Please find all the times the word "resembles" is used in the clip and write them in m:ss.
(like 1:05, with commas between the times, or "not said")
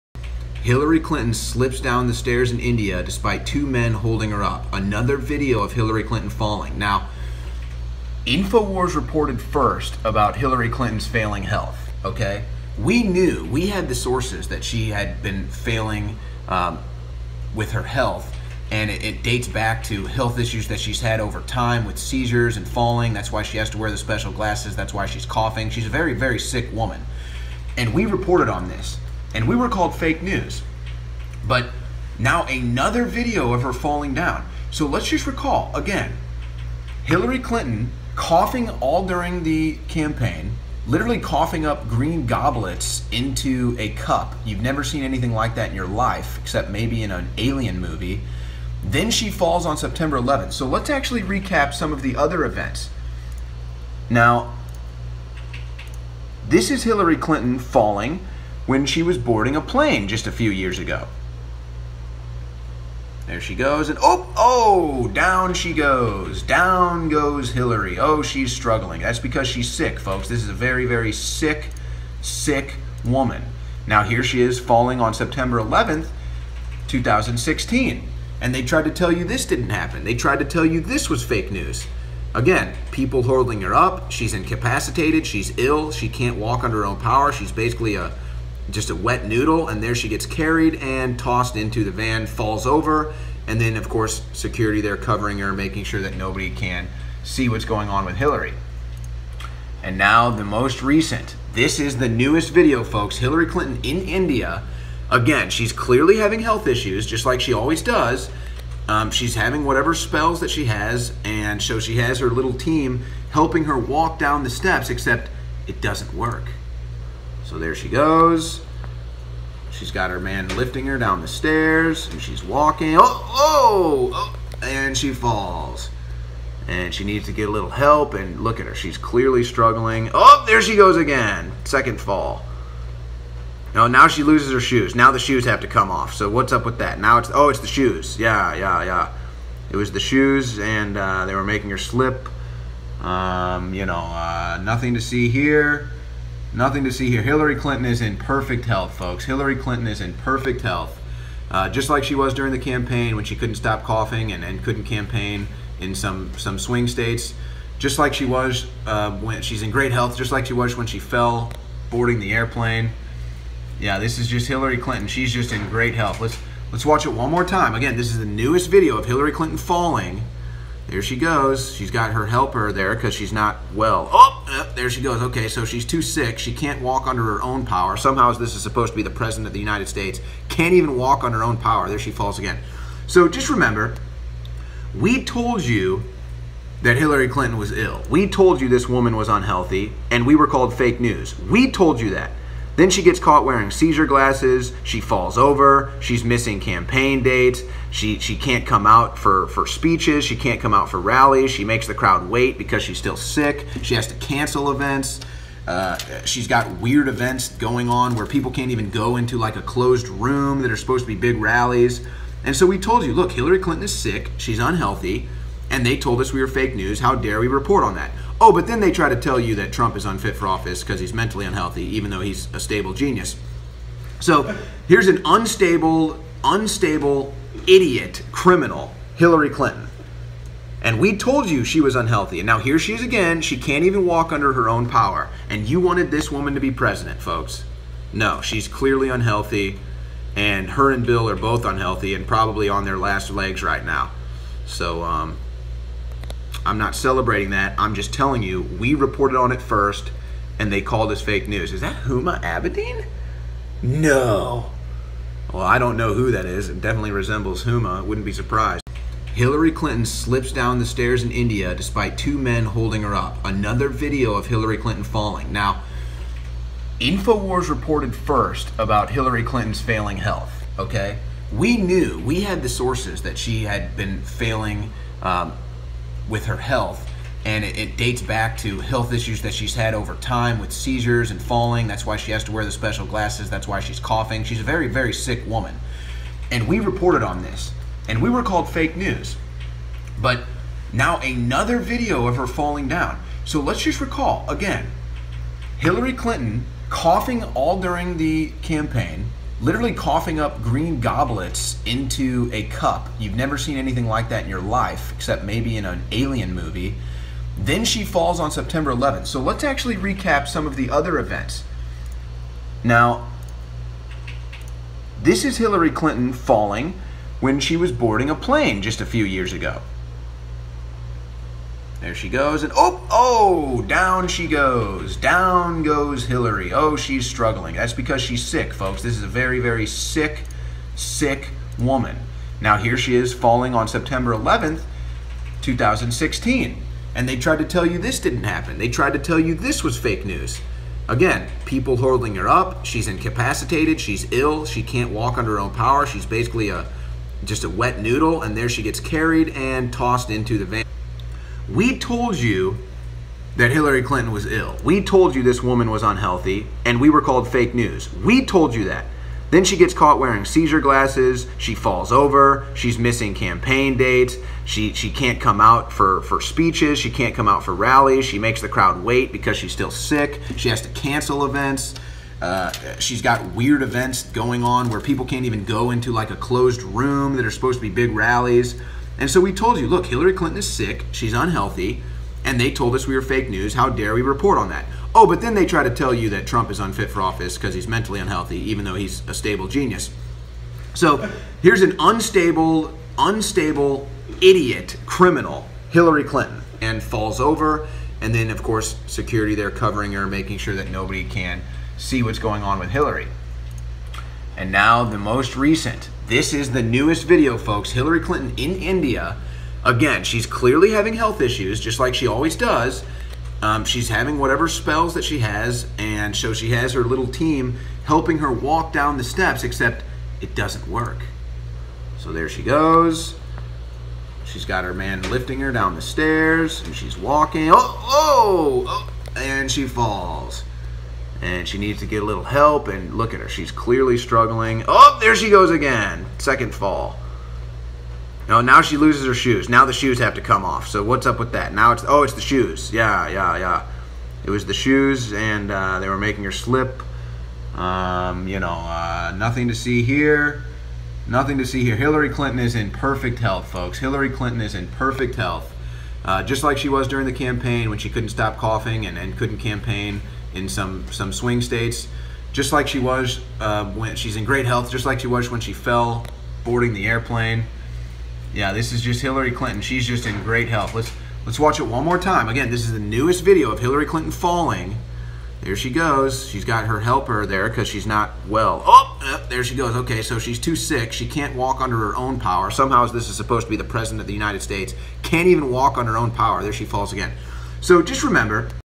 4:17.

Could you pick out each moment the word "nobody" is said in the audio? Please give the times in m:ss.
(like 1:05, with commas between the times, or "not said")
1:36, 6:40.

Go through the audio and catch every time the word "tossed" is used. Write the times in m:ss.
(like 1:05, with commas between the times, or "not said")
1:31, 5:49.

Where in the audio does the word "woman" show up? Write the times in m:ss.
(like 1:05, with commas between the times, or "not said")
0:26, 1:13, 3:08, 3:56, 4:45, 5:31, 5:55.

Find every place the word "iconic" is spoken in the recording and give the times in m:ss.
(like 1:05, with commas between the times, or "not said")
not said.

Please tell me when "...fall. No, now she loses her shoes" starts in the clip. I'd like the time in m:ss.
7:16.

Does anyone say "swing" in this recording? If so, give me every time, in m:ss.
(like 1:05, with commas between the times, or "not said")
2:36, 7:41.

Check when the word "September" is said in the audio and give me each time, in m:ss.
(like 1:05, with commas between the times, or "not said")
0:49, 1:15, 5:08, 5:33.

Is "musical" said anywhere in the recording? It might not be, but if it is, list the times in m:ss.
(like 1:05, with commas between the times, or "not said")
not said.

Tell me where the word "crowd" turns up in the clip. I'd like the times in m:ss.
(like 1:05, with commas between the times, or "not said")
3:21, 6:08.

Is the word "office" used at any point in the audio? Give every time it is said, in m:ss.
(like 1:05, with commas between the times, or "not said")
3:40, 6:27.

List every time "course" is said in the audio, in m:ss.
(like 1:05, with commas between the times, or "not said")
1:33, 6:38.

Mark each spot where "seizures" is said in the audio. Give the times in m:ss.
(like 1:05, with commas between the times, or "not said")
0:21, 3:13, 4:40, 6:00.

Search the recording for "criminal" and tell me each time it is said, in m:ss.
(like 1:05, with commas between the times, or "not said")
3:48, 6:35.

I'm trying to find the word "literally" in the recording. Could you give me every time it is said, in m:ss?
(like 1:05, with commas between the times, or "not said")
0:40, 4:59.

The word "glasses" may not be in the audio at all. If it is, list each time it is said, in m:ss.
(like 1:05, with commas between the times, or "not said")
0:24, 3:14, 4:43, 6:00.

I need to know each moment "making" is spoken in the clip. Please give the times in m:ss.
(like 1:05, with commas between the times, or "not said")
1:35, 2:21, 6:40, 7:26.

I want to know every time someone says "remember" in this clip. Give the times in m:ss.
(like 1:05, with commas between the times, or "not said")
3:03, 8:08.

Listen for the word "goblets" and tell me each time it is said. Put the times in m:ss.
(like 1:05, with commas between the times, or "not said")
0:42, 5:00.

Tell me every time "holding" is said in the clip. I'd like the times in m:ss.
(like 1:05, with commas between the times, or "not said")
0:03, 1:23, 4:22, 5:41.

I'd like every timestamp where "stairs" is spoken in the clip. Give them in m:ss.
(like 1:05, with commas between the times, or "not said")
0:02, 2:01, 4:20, 7:06.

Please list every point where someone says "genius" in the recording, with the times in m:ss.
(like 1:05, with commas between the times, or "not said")
3:42, 6:29.